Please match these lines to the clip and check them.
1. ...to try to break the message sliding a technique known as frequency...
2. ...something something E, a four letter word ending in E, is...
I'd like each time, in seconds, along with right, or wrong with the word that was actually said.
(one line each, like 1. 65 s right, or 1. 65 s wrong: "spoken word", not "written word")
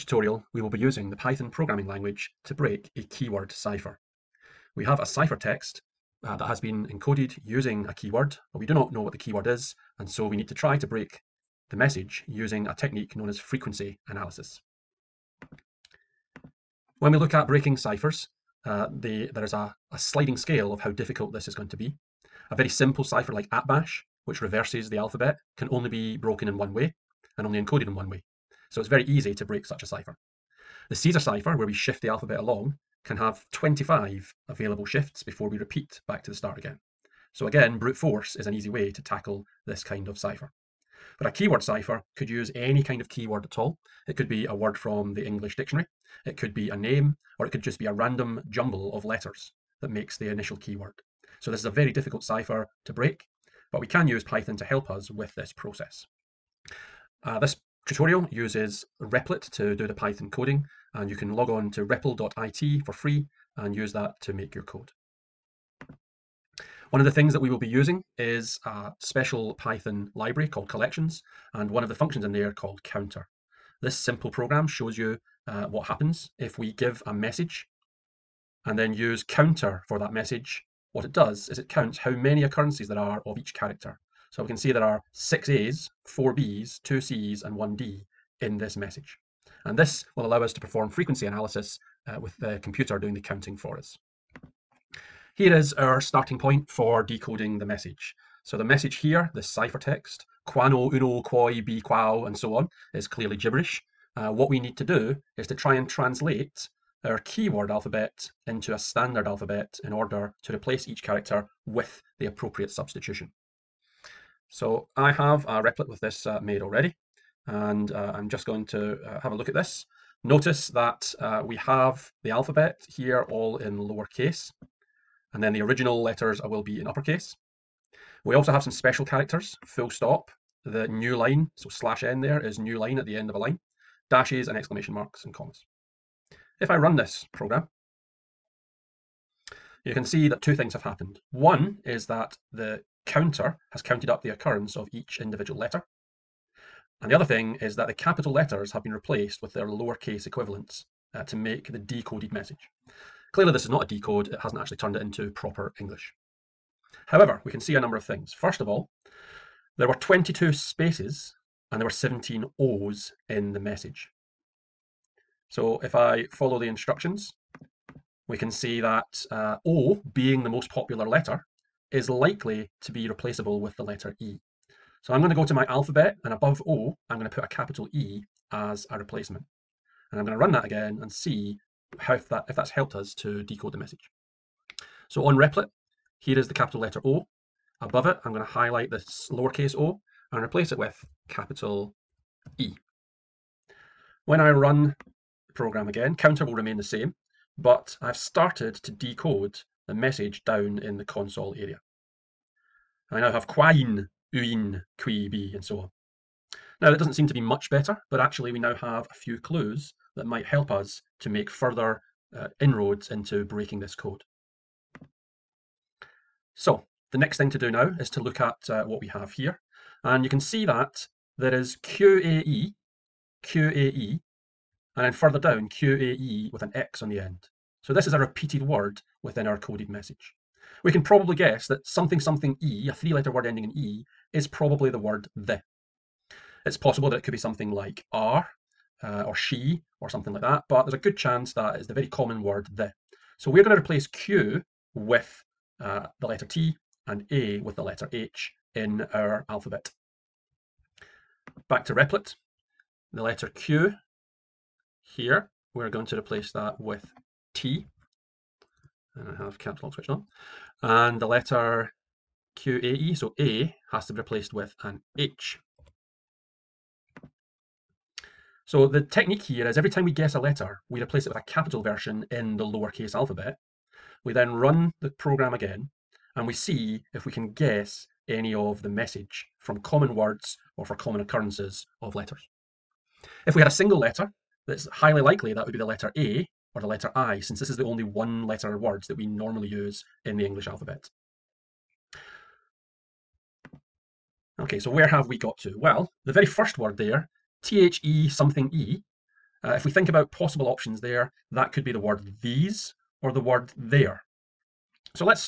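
1. 10 s wrong: "using", not "sliding"
2. 231 s wrong: "three", not "four".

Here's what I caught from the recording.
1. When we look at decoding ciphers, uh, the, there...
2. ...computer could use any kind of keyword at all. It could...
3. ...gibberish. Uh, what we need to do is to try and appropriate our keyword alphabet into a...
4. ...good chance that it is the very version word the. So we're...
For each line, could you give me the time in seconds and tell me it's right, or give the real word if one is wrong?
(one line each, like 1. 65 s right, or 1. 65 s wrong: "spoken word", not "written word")
1. 17 s wrong: "breaking", not "decoding"
2. 41 s wrong: "cipher", not "computer"
3. 103 s wrong: "translate", not "appropriate"
4. 240 s wrong: "common", not "version".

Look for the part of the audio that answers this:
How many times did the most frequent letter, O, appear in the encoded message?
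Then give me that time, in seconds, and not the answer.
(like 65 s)
161 s.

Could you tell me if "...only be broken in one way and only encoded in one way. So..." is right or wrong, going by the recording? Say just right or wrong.
right.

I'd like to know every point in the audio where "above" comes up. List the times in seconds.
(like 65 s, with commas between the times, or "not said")
176 s, 187 s.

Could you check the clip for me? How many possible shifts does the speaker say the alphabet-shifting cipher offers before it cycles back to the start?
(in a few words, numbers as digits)
25.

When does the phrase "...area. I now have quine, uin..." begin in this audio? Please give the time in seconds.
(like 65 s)
201 s.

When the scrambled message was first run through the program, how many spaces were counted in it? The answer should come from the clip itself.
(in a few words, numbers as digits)
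22.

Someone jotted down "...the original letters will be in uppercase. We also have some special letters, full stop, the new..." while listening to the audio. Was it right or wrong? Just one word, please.
wrong.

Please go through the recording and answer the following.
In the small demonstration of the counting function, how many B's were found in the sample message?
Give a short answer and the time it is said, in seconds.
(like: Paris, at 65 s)
4, at 86 s.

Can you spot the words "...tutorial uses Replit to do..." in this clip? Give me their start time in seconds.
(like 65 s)
57 s.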